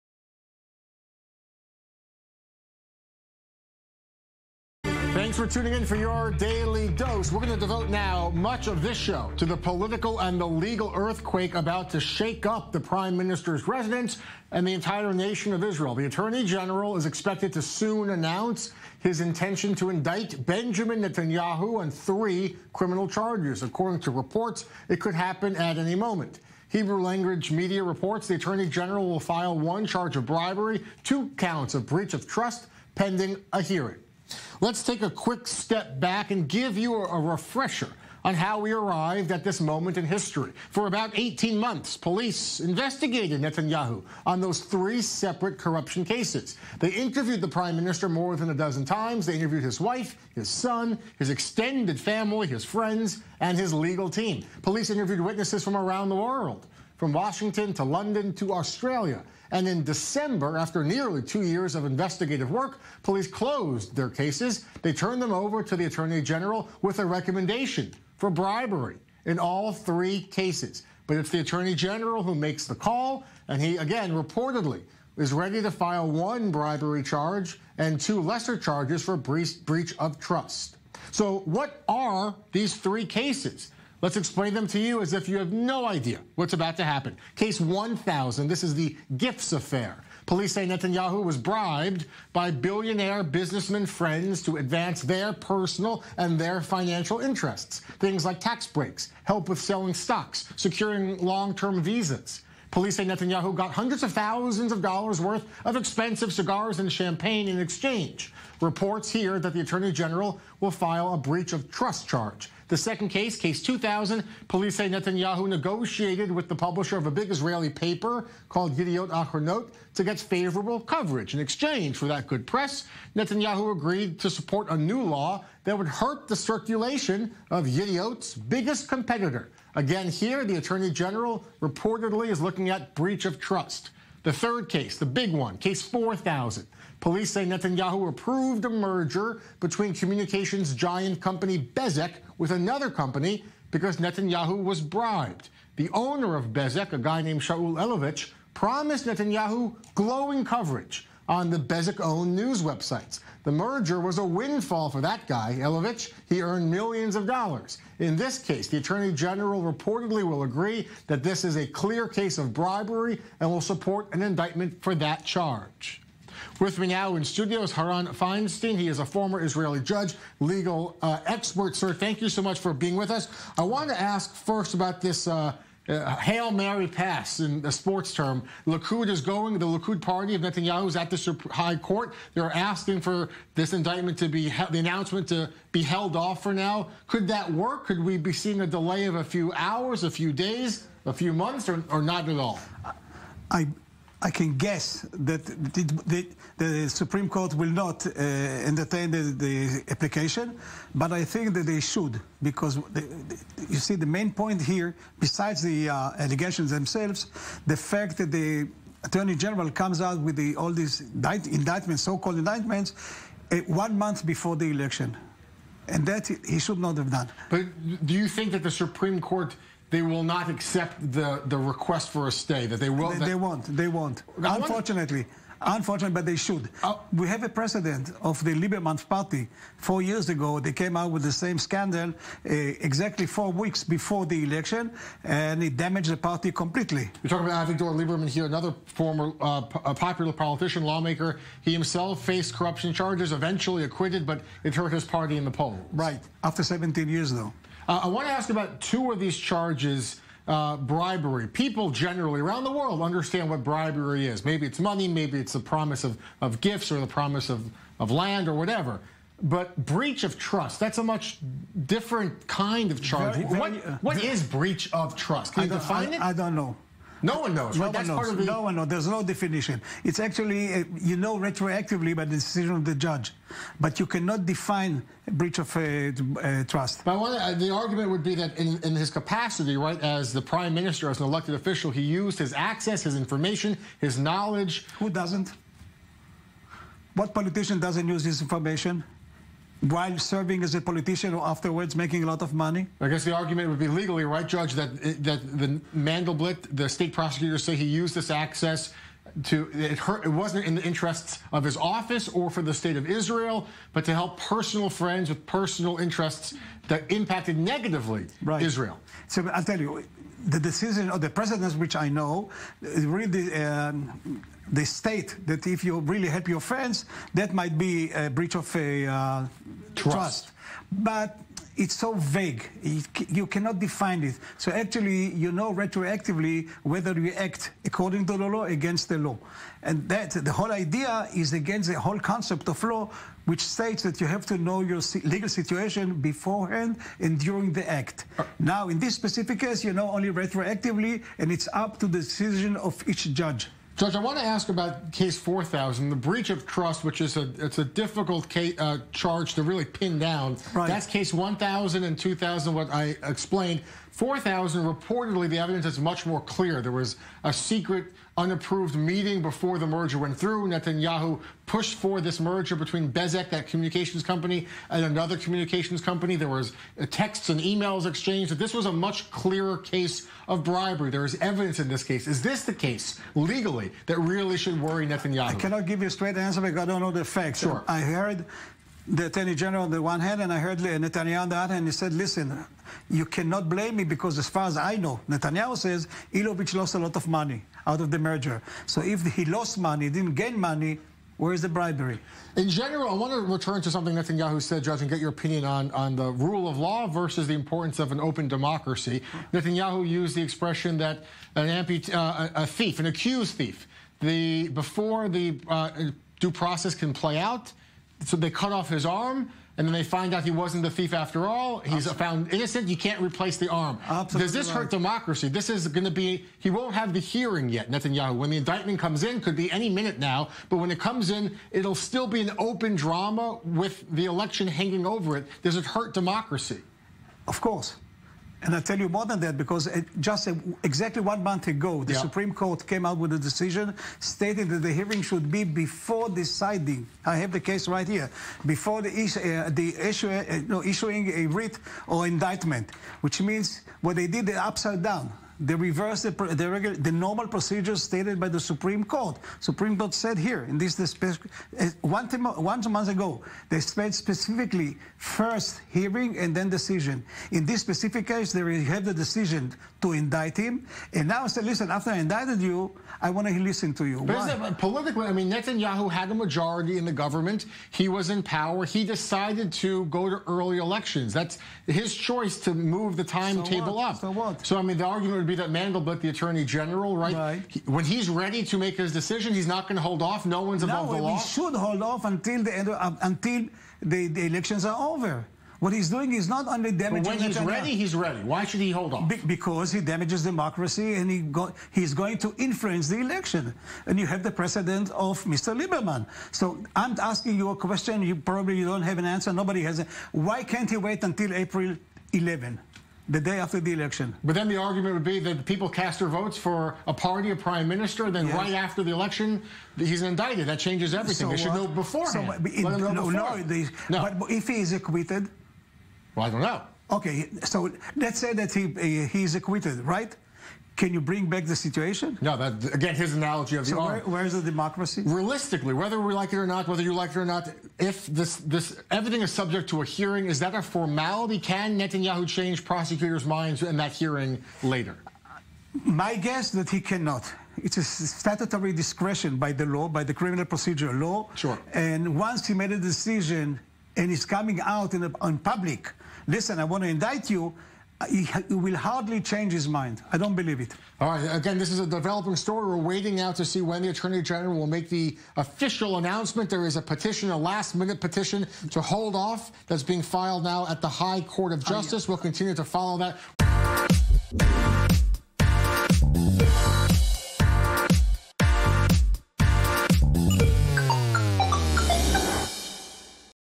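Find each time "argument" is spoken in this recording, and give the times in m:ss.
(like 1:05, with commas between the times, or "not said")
4:37, 4:53, 7:55, 8:24.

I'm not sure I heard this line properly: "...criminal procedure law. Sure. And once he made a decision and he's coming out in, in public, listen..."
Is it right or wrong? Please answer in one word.
right.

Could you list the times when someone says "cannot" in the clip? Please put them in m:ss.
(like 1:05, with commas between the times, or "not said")
4:34, 5:23, 6:15, 6:23, 8:57.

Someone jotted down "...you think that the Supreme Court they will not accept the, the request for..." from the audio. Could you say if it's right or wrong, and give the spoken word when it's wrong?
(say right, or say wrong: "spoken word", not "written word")
right.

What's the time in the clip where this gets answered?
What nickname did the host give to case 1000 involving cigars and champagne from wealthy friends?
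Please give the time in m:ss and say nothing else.
1:28.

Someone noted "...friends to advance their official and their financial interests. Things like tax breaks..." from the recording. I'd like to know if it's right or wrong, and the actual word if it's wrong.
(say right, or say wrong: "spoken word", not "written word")
wrong: "personal", not "official".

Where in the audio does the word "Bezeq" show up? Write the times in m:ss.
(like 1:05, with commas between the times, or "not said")
2:21, 2:26, 2:31, 6:03.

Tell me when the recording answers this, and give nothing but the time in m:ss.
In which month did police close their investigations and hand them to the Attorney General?
0:59.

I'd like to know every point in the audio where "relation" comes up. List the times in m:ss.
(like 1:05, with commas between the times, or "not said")
not said.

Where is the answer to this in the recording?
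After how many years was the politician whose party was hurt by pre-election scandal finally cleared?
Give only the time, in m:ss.
4:06.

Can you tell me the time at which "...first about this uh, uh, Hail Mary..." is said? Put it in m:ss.
2:54.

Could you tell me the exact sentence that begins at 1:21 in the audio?
So, what are these three cases?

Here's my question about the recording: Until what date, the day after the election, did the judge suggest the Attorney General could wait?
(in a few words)
April 11.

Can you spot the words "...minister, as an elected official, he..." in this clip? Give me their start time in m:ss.
4:40.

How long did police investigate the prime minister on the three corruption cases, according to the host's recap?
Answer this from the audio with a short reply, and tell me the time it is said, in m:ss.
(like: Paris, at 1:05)
18 months, at 0:41.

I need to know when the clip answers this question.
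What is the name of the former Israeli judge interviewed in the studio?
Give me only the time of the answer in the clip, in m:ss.
2:47.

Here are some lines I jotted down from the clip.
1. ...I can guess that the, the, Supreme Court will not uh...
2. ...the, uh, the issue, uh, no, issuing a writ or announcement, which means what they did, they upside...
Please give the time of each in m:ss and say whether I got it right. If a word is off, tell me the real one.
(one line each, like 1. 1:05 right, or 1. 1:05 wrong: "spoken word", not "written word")
1. 3:14 right
2. 7:19 wrong: "indictment", not "announcement".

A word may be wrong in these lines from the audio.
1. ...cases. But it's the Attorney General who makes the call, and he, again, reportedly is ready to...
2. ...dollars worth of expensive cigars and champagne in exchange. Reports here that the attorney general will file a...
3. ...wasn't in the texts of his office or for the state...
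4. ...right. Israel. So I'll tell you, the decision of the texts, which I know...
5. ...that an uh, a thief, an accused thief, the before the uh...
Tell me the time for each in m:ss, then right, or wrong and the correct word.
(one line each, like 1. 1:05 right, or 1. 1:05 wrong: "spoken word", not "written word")
1. 1:10 right
2. 1:44 right
3. 5:00 wrong: "interests", not "texts"
4. 5:08 wrong: "presidents", not "texts"
5. 6:40 right.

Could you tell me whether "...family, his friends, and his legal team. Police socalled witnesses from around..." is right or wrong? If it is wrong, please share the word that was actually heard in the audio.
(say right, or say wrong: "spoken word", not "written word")
wrong: "interviewed", not "socalled".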